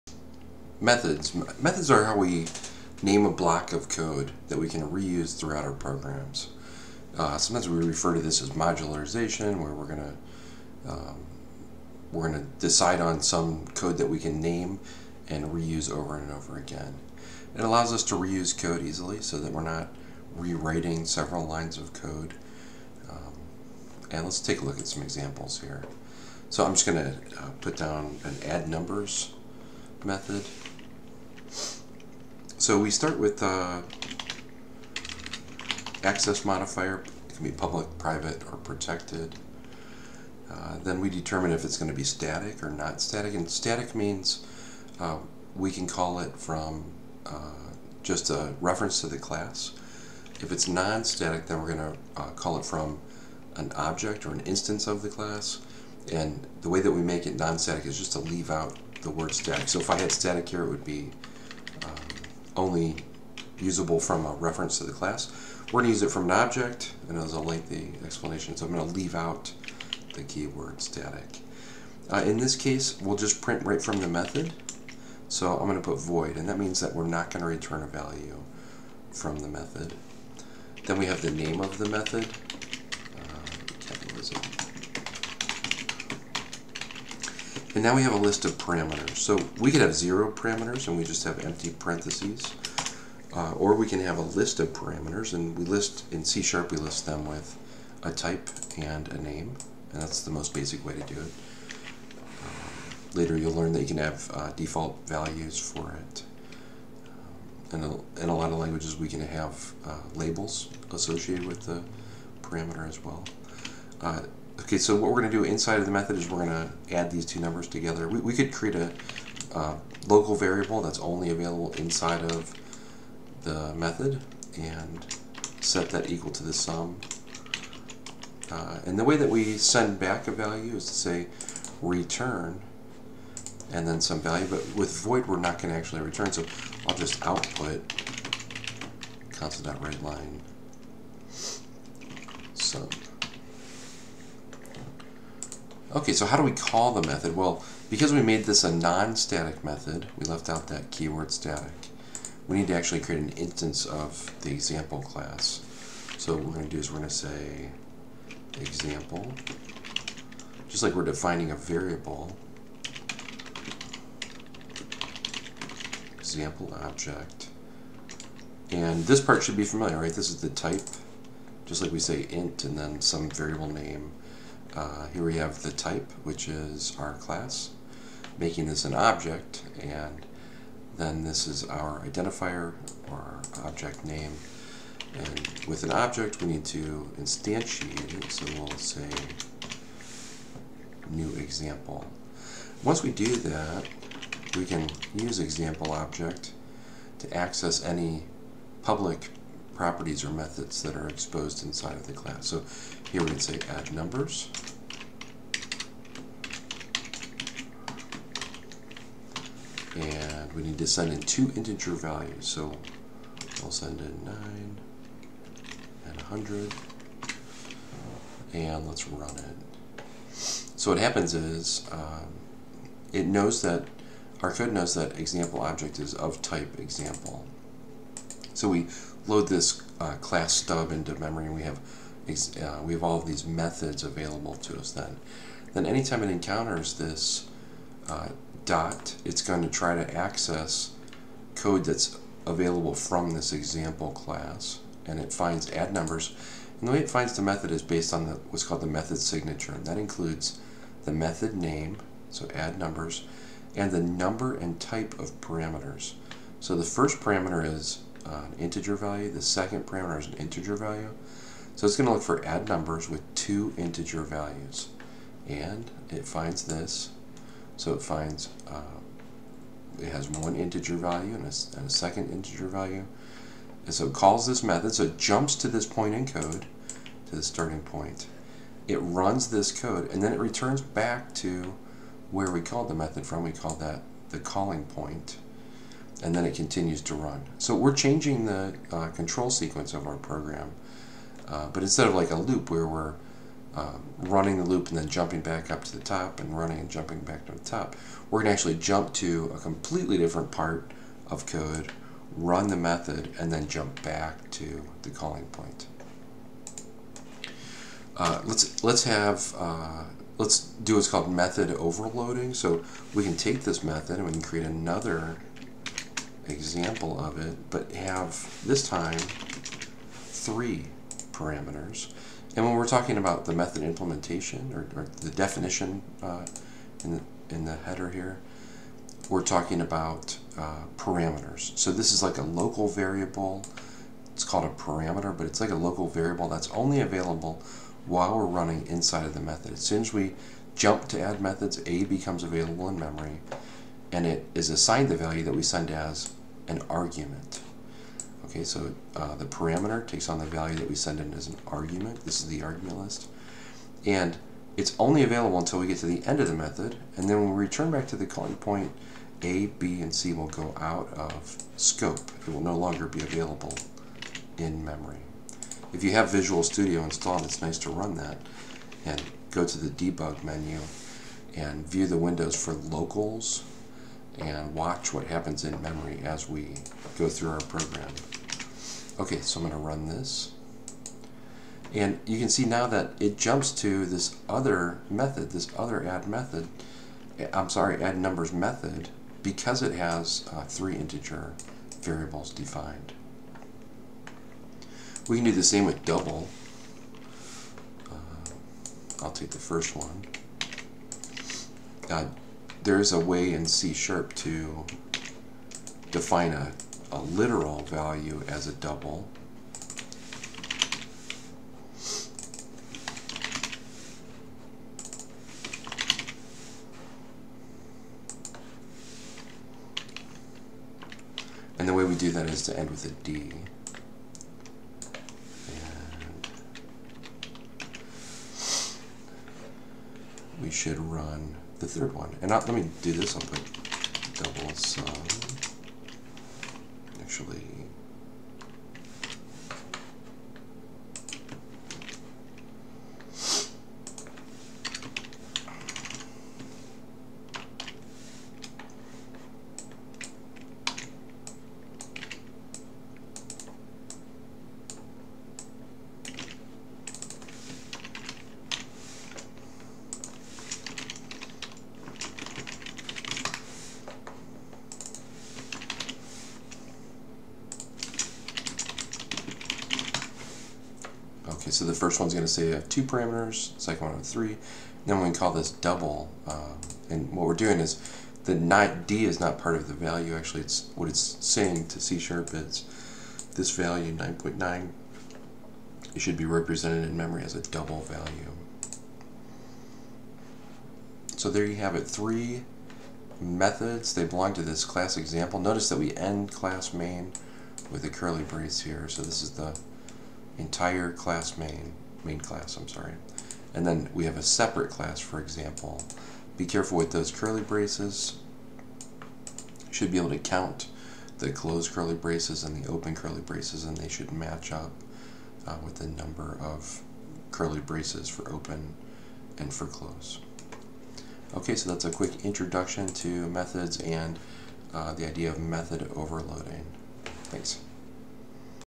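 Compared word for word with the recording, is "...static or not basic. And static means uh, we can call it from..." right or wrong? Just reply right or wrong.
wrong.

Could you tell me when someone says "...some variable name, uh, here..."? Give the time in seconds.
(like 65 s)
173 s.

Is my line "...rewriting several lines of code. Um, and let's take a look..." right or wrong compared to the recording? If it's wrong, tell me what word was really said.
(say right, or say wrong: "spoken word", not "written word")
right.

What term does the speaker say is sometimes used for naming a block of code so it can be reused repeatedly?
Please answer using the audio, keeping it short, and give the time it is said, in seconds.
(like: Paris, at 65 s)
modularization, at 8 s.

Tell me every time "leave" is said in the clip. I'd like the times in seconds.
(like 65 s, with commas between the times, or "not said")
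58 s, 68 s.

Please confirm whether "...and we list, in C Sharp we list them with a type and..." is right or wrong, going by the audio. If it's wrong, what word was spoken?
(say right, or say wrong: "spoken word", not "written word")
right.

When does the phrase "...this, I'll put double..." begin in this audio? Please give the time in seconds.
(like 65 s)
433 s.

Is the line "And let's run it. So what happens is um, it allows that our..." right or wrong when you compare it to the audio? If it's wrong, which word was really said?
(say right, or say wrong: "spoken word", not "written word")
wrong: "knows", not "allows".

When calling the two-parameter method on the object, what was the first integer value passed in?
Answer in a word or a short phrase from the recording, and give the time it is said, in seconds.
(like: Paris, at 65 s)
9, at 214 s.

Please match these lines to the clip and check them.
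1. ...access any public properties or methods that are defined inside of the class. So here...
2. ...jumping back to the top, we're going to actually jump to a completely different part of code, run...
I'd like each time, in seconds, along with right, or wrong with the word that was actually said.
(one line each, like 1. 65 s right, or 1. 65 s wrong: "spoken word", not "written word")
1. 197 s wrong: "exposed", not "defined"
2. 296 s right.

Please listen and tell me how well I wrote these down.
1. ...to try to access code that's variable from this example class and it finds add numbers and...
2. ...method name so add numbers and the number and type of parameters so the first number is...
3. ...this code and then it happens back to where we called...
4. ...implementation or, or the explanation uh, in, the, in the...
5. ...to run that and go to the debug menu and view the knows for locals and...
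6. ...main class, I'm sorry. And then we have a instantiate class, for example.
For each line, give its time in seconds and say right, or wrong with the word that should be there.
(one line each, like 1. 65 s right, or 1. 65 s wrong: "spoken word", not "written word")
1. 239 s wrong: "available", not "variable"
2. 251 s wrong: "parameter", not "number"
3. 279 s wrong: "returns", not "happens"
4. 323 s wrong: "definition", not "explanation"
5. 367 s wrong: "windows", not "knows"
6. 502 s wrong: "separate", not "instantiate".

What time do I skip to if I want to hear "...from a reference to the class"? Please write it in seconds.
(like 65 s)
63 s.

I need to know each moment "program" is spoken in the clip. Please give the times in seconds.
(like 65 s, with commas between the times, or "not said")
5 s, 290 s, 377 s.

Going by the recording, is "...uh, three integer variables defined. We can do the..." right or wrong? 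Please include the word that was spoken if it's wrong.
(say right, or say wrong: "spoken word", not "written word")
right.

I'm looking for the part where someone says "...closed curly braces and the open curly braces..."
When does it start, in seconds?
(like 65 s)
511 s.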